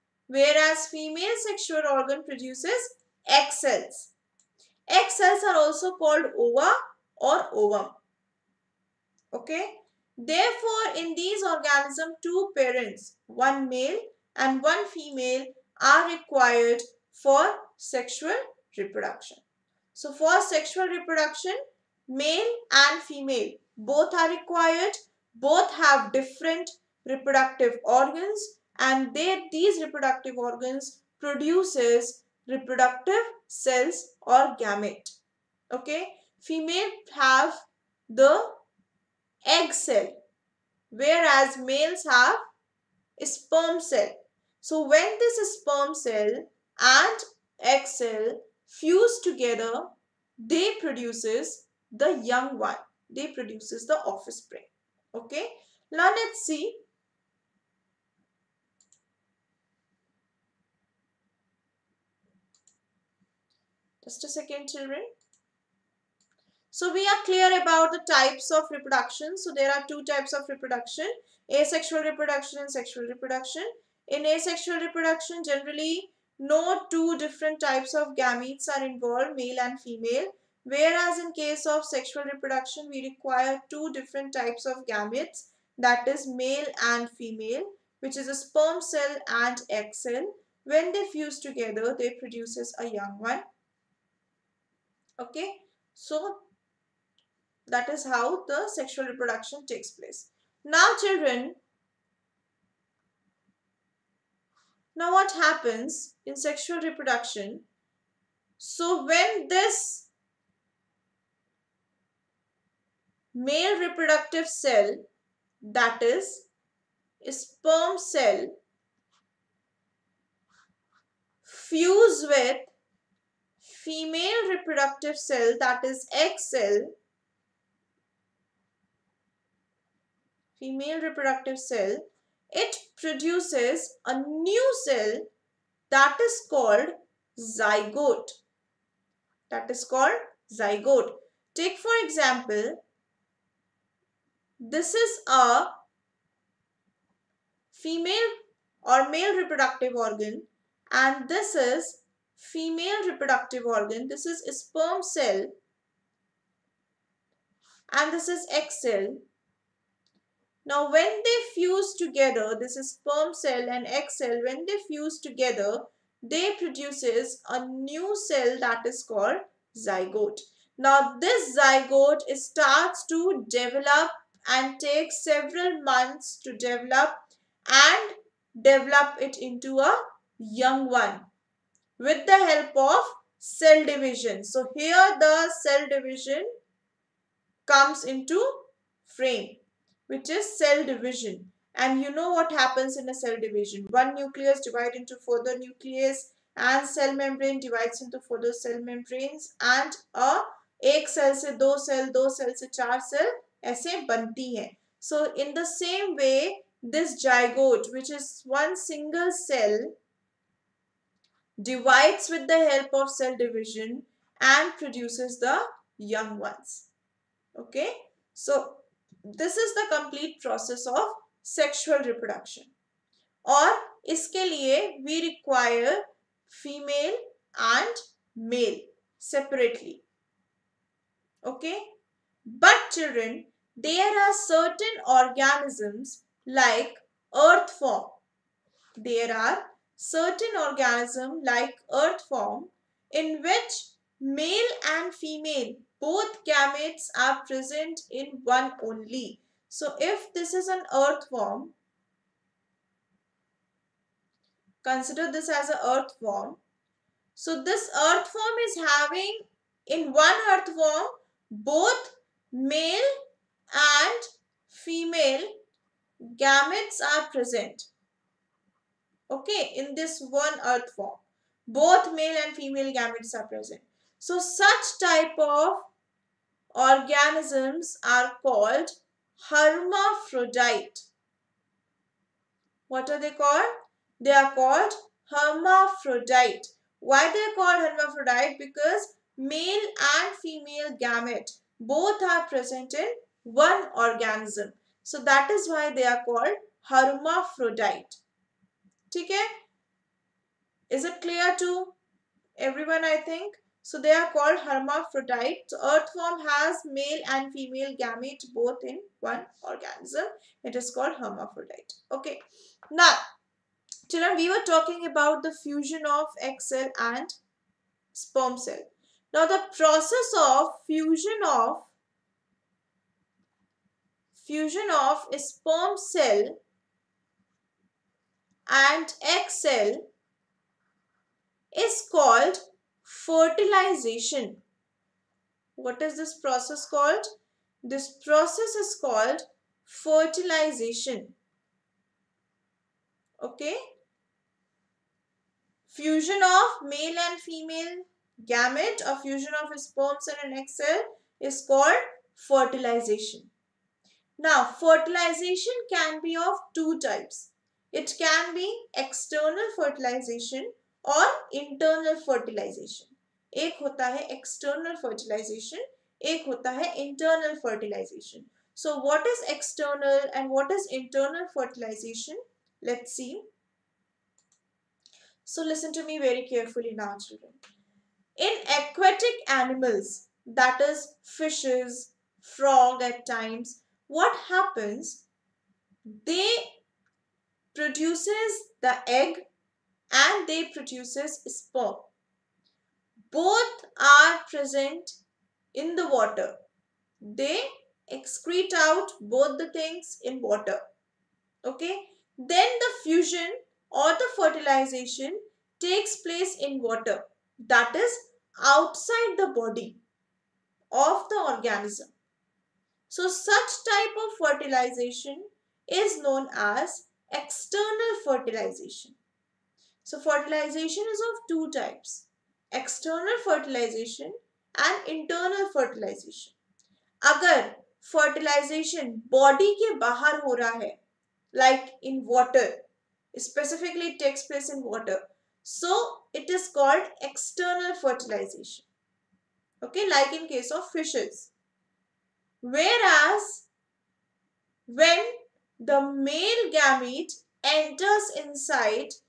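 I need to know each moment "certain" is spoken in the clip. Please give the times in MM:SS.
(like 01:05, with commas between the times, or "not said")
03:54, 03:59.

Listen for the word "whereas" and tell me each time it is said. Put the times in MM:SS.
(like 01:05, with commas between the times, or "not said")
00:00, 00:40, 01:20, 07:22.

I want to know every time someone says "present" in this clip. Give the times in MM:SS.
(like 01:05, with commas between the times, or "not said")
04:07, 04:27, 04:33, 04:52, 06:34.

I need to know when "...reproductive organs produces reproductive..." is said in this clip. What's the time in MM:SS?
00:29.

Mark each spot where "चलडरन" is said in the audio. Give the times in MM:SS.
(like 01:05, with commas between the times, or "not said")
06:17.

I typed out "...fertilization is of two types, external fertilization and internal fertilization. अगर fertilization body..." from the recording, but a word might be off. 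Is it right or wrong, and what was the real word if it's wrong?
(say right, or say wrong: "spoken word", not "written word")
right.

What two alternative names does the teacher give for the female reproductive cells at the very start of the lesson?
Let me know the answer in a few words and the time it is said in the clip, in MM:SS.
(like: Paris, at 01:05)
ova or ovum, at 00:06.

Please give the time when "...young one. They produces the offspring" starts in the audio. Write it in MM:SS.
00:52.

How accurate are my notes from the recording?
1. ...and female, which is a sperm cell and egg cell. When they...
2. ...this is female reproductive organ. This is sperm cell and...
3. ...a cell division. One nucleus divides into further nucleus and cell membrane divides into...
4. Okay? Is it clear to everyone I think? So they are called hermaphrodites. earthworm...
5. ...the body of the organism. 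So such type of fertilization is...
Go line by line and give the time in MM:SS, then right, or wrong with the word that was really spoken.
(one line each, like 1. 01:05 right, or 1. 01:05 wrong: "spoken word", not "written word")
1. 01:26 right
2. 02:31 right
3. 03:13 right
4. 04:59 right
5. 06:49 right.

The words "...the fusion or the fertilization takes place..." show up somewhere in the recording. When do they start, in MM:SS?
06:42.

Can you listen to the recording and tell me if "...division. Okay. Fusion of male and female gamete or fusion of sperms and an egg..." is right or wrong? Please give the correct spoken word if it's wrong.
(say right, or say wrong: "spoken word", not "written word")
wrong: "fertilization", not "division".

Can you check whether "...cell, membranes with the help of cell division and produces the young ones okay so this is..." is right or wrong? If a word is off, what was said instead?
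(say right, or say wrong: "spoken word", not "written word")
wrong: "divides", not "membranes".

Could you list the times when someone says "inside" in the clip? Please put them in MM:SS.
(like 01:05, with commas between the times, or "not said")
07:28.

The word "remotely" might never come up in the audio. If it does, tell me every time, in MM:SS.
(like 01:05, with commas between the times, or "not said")
not said.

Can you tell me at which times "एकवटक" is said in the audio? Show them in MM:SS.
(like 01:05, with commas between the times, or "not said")
06:18.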